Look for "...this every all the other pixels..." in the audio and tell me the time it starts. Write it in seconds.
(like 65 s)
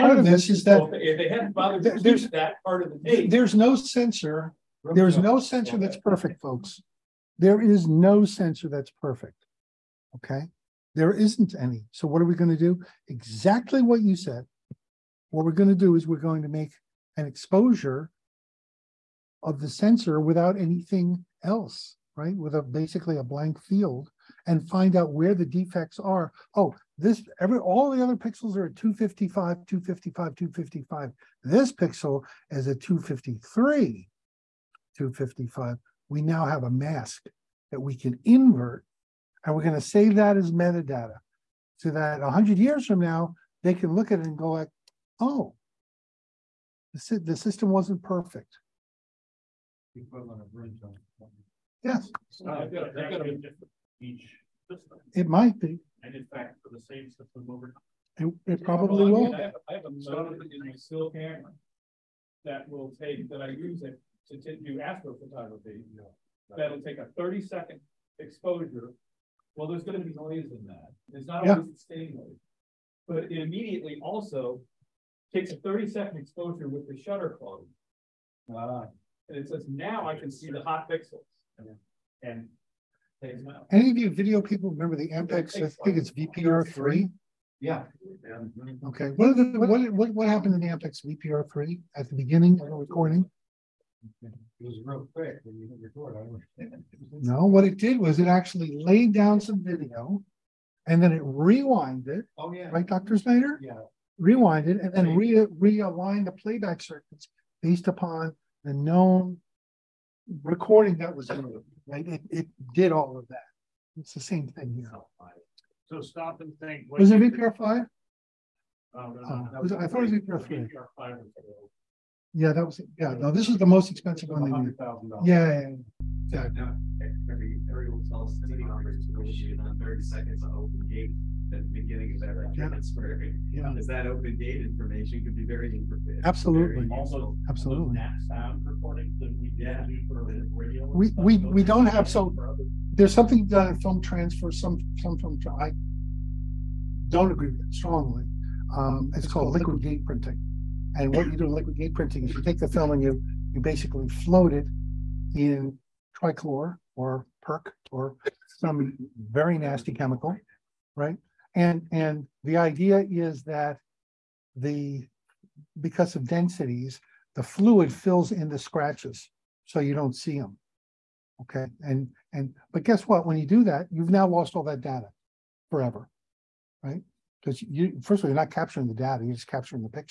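26 s.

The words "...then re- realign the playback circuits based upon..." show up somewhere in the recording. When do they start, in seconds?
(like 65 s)
104 s.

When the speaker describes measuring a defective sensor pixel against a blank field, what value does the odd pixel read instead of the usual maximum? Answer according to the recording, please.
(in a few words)
253.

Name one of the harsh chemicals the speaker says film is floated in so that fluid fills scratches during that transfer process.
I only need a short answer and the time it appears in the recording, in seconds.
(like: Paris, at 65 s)
trichlor, at 156 s.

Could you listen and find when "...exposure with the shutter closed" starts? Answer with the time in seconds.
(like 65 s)
76 s.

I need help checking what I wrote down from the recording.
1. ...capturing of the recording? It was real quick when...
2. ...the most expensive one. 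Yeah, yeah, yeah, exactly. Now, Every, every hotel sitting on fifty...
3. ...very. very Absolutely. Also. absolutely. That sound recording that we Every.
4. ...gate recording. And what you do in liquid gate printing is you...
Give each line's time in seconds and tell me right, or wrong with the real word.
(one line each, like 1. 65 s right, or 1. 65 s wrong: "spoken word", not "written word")
1. 92 s wrong: "beginning", not "capturing"
2. 123 s wrong: "thirty", not "fifty"
3. 135 s wrong: "Yeah", not "Every"
4. 149 s wrong: "printing", not "recording".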